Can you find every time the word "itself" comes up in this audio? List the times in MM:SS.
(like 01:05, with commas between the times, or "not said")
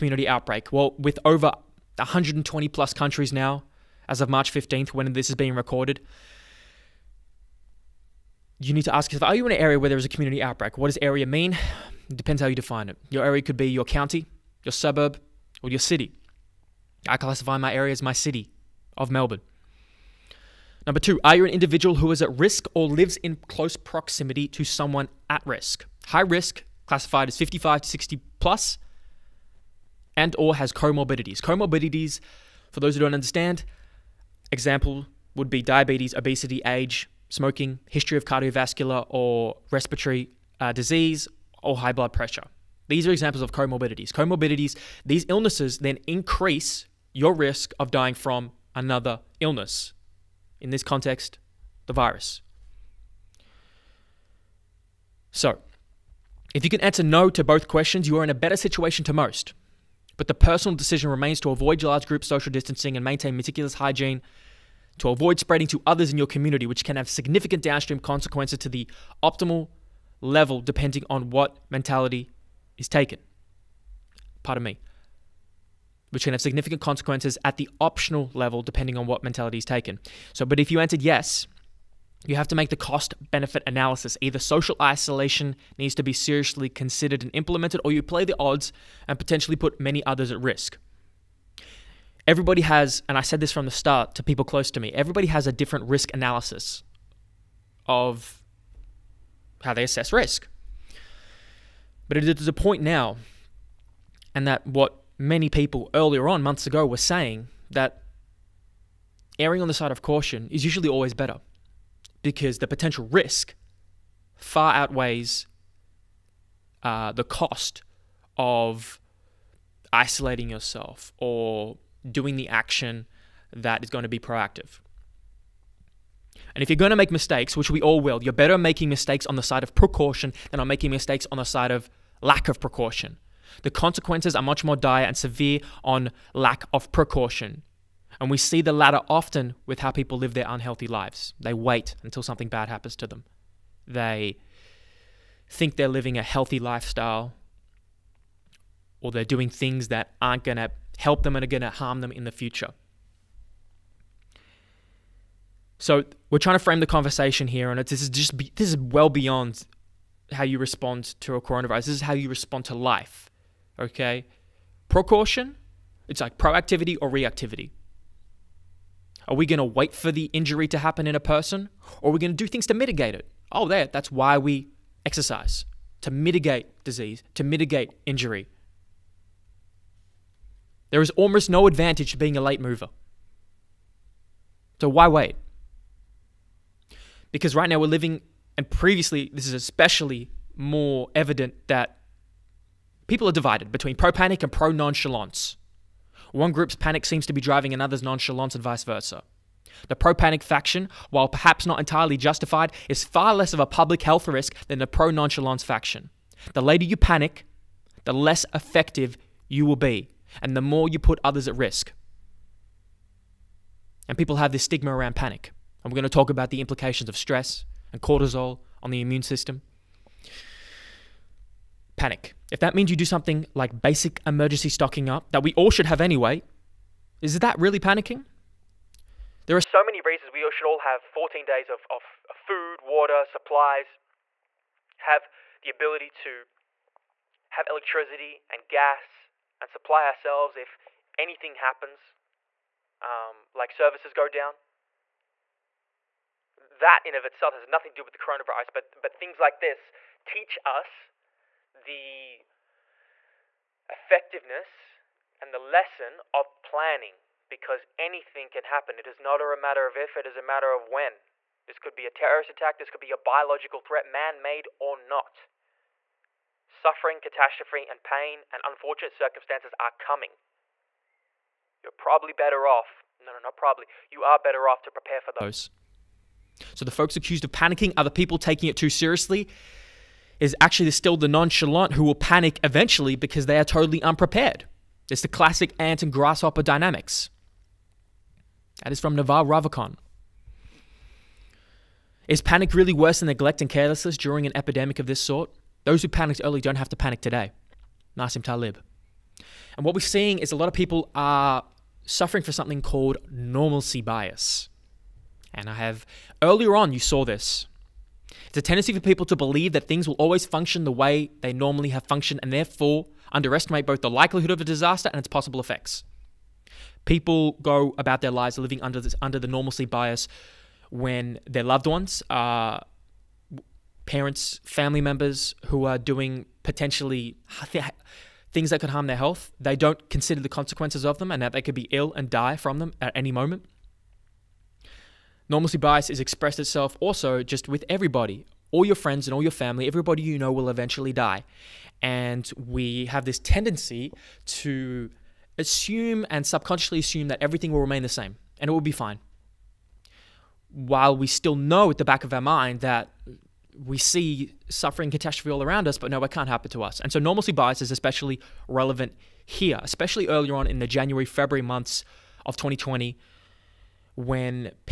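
04:07, 05:36.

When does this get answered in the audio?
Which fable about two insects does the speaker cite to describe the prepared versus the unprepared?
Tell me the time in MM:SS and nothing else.
04:45.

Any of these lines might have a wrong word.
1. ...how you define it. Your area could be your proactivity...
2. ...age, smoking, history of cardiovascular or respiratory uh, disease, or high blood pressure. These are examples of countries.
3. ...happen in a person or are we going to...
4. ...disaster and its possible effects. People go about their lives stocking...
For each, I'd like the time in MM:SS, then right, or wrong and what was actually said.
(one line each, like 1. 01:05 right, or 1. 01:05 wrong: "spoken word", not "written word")
1. 00:12 wrong: "county", not "proactivity"
2. 00:36 wrong: "comorbidities", not "countries"
3. 02:50 right
4. 05:14 wrong: "living", not "stocking".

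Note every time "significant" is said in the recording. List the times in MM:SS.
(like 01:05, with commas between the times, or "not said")
01:07, 01:16.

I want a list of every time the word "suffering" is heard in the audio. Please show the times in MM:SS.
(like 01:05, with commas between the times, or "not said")
04:26, 05:02, 05:54.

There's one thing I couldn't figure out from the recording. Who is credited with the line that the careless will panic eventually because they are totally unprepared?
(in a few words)
Naval Ravikant.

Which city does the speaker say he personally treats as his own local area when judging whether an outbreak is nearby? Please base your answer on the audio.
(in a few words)
Melbourne.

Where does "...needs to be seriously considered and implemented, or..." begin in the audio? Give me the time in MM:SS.
01:25.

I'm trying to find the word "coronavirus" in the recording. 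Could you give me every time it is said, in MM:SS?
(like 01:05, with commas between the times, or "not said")
02:41, 04:08.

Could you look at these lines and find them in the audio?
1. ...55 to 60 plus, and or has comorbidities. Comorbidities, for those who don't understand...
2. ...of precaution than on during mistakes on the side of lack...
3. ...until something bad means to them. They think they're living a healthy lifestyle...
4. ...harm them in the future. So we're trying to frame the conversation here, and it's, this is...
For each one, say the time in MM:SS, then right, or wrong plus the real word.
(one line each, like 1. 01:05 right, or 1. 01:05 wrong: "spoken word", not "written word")
1. 00:27 right
2. 02:09 wrong: "making", not "during"
3. 02:22 wrong: "happens", not "means"
4. 02:31 right.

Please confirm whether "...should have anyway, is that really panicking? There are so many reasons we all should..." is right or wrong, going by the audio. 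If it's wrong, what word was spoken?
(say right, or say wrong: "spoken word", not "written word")
right.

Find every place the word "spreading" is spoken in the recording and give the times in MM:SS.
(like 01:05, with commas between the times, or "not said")
01:05.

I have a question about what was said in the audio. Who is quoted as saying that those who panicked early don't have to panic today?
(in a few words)
Nassim Taleb.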